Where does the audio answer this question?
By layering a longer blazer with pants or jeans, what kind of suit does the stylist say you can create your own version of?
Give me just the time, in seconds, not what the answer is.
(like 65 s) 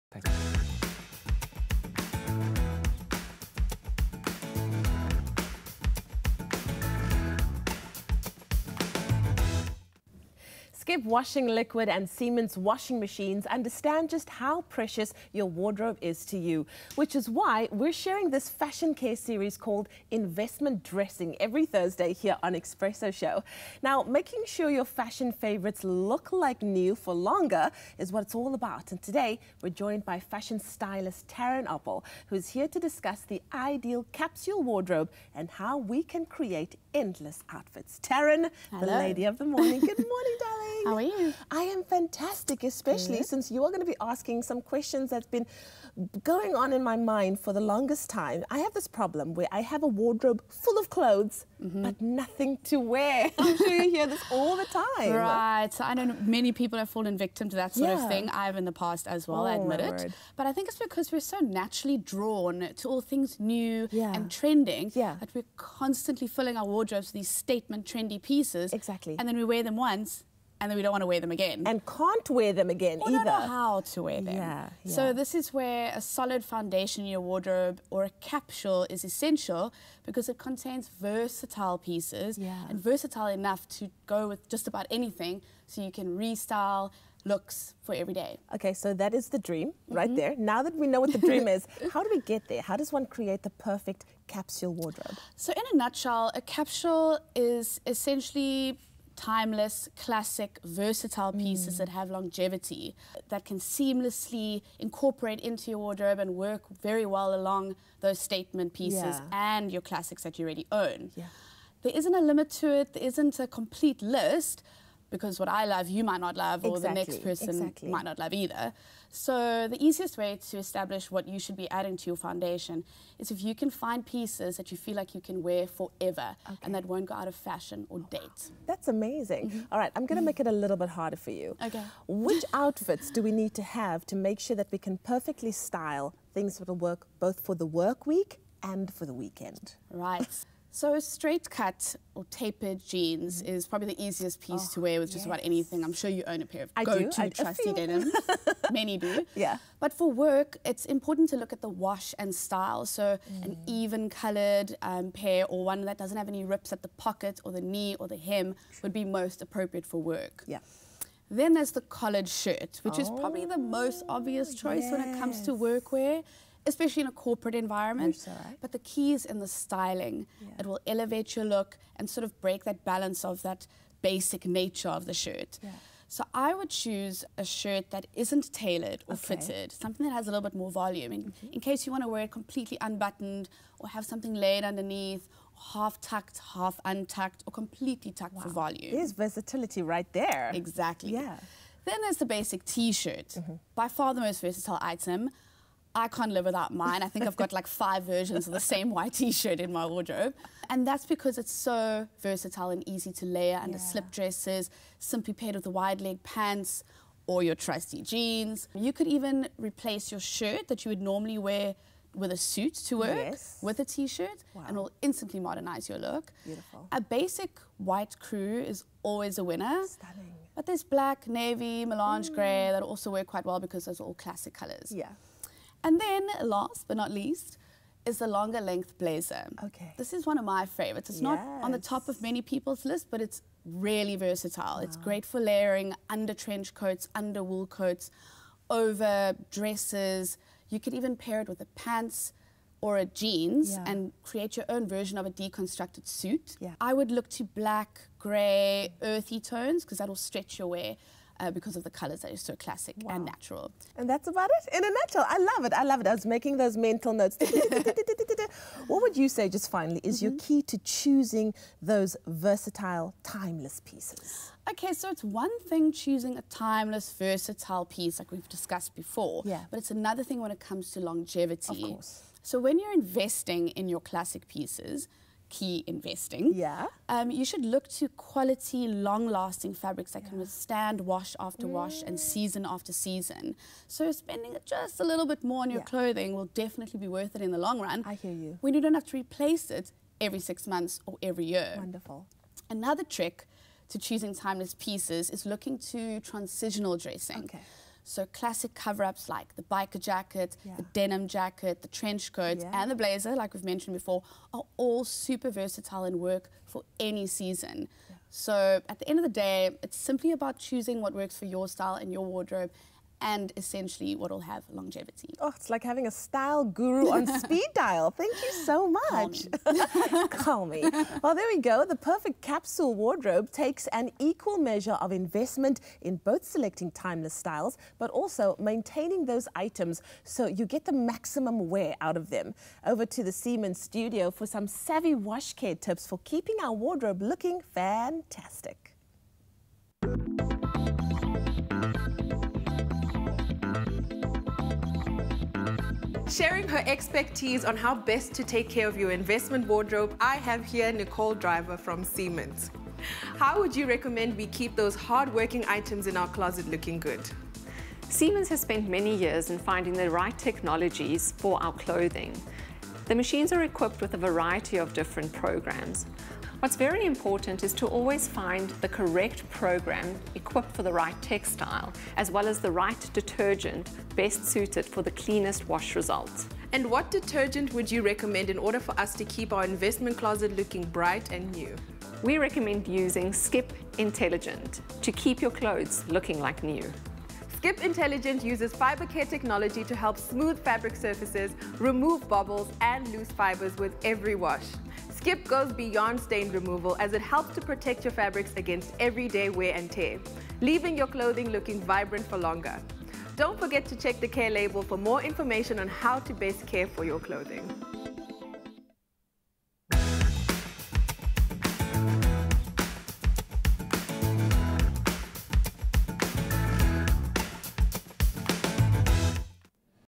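245 s.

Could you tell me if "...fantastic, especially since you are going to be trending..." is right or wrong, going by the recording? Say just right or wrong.
wrong.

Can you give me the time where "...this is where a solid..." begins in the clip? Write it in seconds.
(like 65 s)
75 s.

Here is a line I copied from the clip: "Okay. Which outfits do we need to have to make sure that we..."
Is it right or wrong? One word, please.
right.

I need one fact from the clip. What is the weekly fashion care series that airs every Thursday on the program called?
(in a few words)
Investment Dressing.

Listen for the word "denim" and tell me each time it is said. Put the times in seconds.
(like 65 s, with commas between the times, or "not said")
147 s, 300 s.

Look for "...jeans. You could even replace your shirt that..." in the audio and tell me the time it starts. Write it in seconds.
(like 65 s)
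208 s.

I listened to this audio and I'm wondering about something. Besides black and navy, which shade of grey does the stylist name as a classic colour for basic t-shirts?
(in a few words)
melange.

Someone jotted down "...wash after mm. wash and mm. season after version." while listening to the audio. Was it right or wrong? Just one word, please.
wrong.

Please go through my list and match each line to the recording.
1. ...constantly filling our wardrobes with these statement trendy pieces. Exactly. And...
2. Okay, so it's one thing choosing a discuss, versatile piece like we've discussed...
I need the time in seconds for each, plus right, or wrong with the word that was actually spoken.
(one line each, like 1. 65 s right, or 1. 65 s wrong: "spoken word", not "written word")
1. 65 s right
2. 264 s wrong: "timeless", not "discuss".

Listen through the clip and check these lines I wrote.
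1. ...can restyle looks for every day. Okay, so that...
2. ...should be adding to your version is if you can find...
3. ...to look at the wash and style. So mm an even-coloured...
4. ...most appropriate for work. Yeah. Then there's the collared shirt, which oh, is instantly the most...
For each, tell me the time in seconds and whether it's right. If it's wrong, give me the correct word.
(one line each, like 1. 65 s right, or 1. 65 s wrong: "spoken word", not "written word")
1. 85 s right
2. 121 s wrong: "foundation", not "version"
3. 151 s right
4. 159 s wrong: "probably", not "instantly".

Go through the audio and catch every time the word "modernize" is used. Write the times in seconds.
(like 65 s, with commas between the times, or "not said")
215 s.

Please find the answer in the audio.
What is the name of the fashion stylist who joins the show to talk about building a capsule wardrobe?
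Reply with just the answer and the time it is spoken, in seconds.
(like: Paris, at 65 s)
Tarryn Oppel, at 31 s.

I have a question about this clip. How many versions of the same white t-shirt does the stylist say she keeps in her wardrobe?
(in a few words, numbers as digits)
5.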